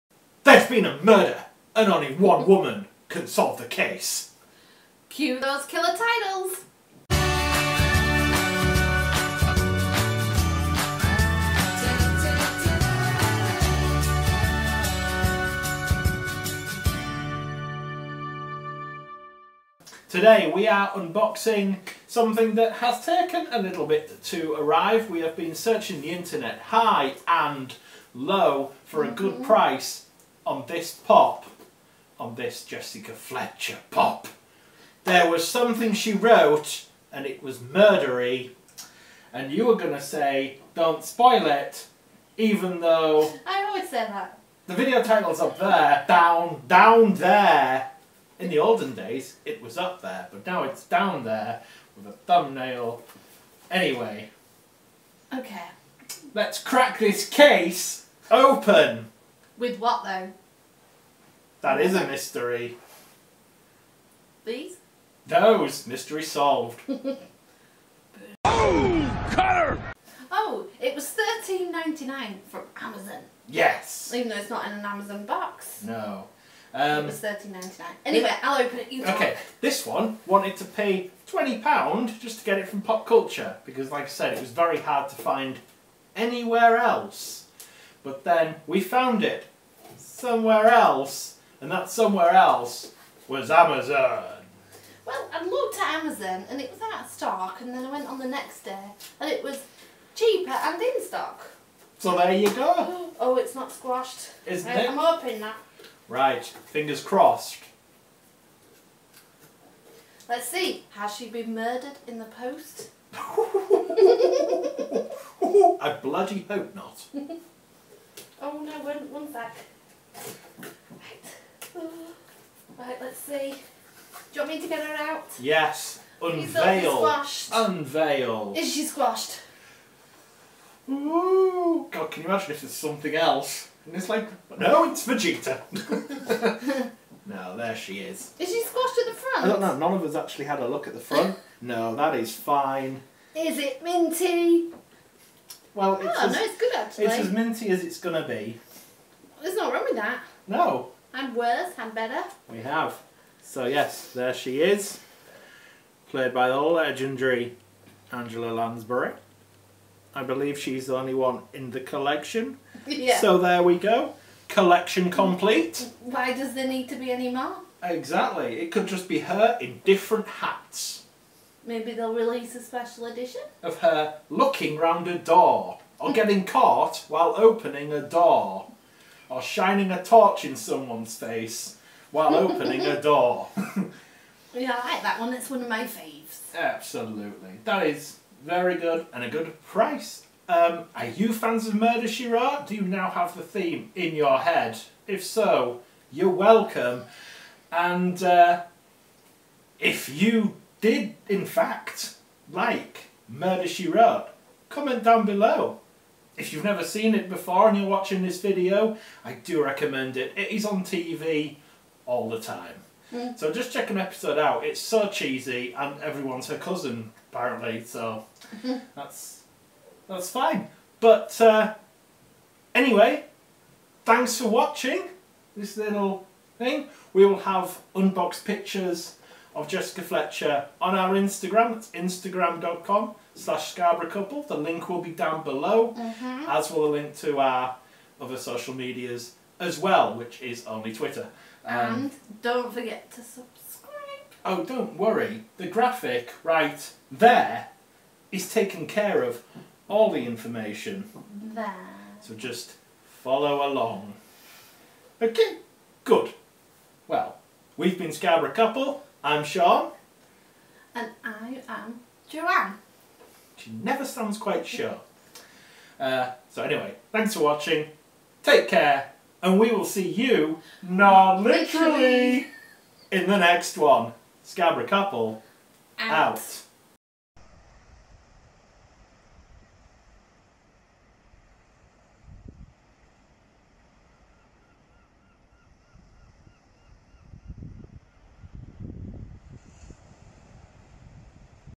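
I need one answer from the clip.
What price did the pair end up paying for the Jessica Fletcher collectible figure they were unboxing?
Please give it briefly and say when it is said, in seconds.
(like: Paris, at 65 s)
£13.99, at 71 s.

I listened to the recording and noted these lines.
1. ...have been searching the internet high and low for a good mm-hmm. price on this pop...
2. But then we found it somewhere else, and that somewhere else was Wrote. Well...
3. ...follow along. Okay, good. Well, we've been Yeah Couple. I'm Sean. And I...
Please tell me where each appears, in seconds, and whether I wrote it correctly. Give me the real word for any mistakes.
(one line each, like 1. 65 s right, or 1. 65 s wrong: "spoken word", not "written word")
1. 25 s right
2. 88 s wrong: "Amazon", not "Wrote"
3. 253 s wrong: "Scarborough", not "Yeah".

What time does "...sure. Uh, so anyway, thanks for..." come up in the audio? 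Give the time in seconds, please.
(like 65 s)
264 s.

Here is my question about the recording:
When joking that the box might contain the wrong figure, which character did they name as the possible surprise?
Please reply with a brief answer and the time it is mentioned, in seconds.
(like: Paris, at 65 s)
Vegeta, at 135 s.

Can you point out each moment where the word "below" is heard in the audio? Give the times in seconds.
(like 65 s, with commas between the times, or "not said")
205 s, 235 s.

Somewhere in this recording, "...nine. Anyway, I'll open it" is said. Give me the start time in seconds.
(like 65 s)
77 s.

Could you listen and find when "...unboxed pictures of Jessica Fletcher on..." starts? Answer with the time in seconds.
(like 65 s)
227 s.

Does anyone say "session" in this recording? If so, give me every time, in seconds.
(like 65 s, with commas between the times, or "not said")
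not said.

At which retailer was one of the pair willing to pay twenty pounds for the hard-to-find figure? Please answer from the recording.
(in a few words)
Pop Culture.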